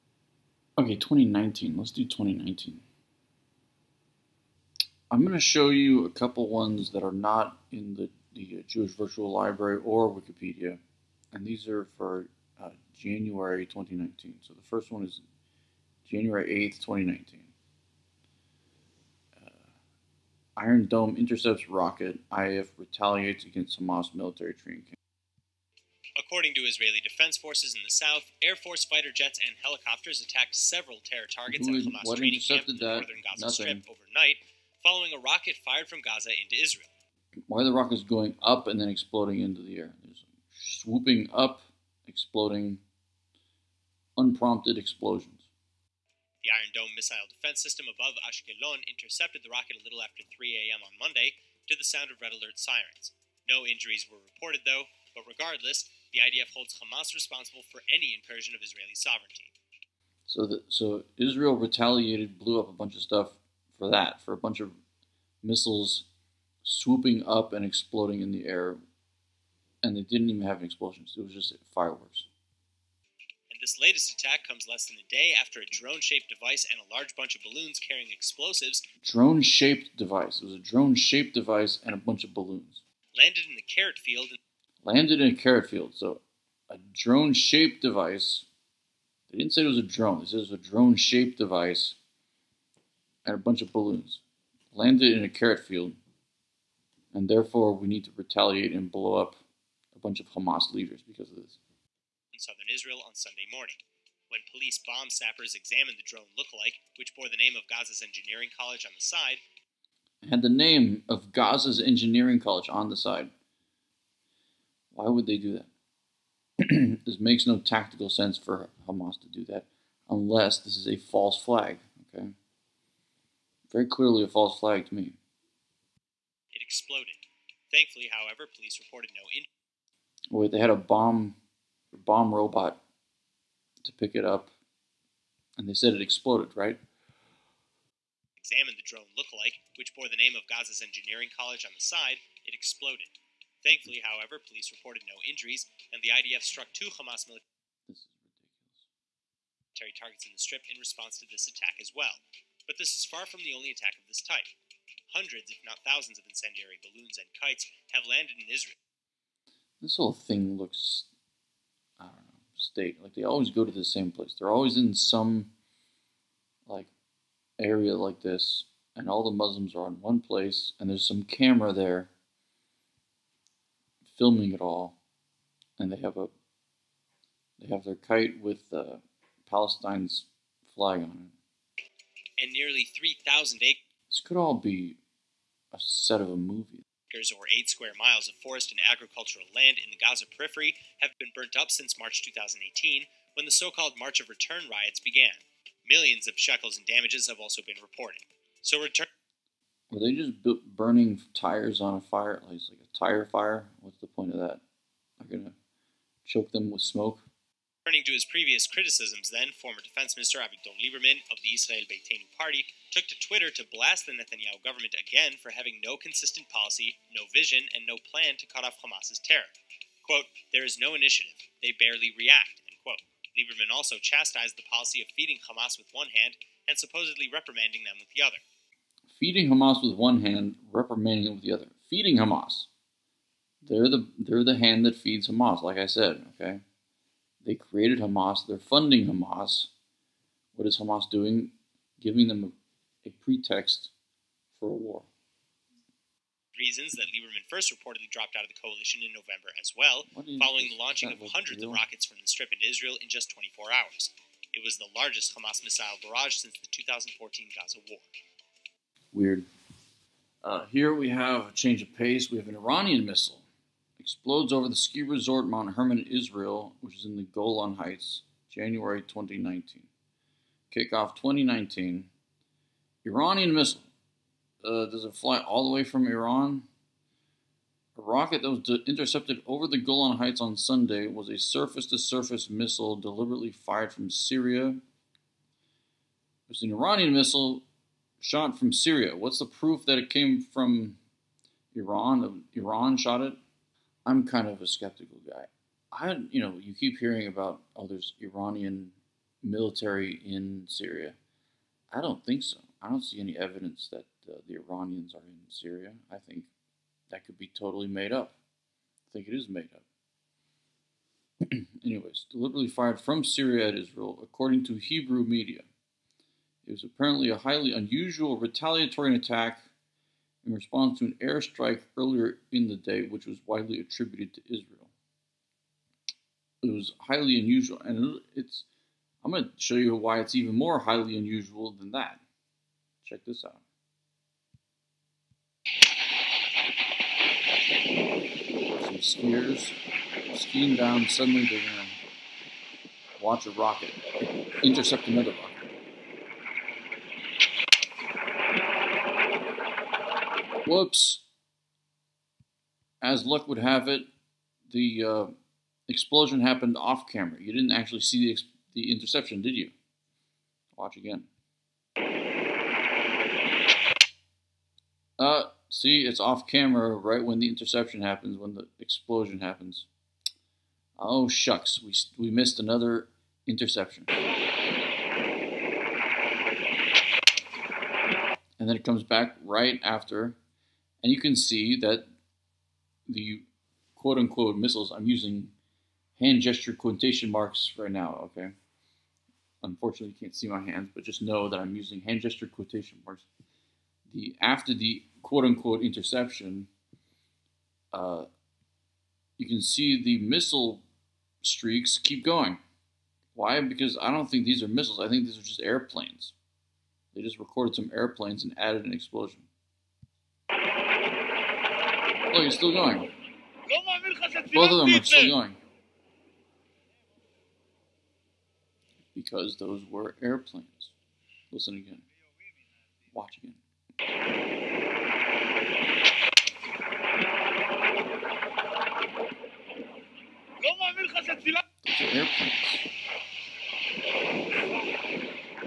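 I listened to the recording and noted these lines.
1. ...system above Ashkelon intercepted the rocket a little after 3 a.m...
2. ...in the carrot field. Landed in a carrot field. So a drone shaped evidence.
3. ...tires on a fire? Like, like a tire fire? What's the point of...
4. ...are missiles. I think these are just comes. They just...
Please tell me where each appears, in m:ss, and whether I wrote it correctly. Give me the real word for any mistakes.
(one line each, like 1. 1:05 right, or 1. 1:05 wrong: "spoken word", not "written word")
1. 0:47 right
2. 1:23 wrong: "device", not "evidence"
3. 3:21 right
4. 6:44 wrong: "airplanes", not "comes".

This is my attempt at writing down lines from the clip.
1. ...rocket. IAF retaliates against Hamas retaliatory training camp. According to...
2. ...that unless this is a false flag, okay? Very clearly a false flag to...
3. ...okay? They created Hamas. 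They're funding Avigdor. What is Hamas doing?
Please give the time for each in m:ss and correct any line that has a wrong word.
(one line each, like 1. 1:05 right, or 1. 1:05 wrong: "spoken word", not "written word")
1. 0:21 wrong: "military", not "retaliatory"
2. 1:59 right
3. 3:56 wrong: "Hamas", not "Avigdor".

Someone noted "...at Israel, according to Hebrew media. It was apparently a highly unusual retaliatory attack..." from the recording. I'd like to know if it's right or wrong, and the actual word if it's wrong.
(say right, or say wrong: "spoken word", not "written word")
right.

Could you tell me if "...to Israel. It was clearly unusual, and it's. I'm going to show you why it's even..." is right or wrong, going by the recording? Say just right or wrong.
wrong.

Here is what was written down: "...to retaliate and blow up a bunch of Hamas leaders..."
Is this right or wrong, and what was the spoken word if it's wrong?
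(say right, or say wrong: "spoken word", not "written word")
right.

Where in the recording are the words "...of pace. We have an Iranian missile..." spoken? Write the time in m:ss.
4:21.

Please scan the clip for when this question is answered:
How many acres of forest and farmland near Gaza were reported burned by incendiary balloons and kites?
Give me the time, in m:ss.
3:02.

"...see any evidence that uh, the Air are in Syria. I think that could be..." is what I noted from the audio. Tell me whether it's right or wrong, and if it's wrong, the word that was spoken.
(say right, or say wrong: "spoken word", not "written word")
wrong: "Iranians", not "Air".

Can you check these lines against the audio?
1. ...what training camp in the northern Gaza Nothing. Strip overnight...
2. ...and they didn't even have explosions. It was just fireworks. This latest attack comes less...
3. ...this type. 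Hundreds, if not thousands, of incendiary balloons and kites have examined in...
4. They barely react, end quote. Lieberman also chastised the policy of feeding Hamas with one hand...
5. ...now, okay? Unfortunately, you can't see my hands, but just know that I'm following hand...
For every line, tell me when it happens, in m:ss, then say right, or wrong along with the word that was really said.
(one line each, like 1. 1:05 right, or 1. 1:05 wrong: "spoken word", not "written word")
1. 0:32 right
2. 1:09 right
3. 2:34 wrong: "landed", not "examined"
4. 3:41 right
5. 6:27 wrong: "using", not "following".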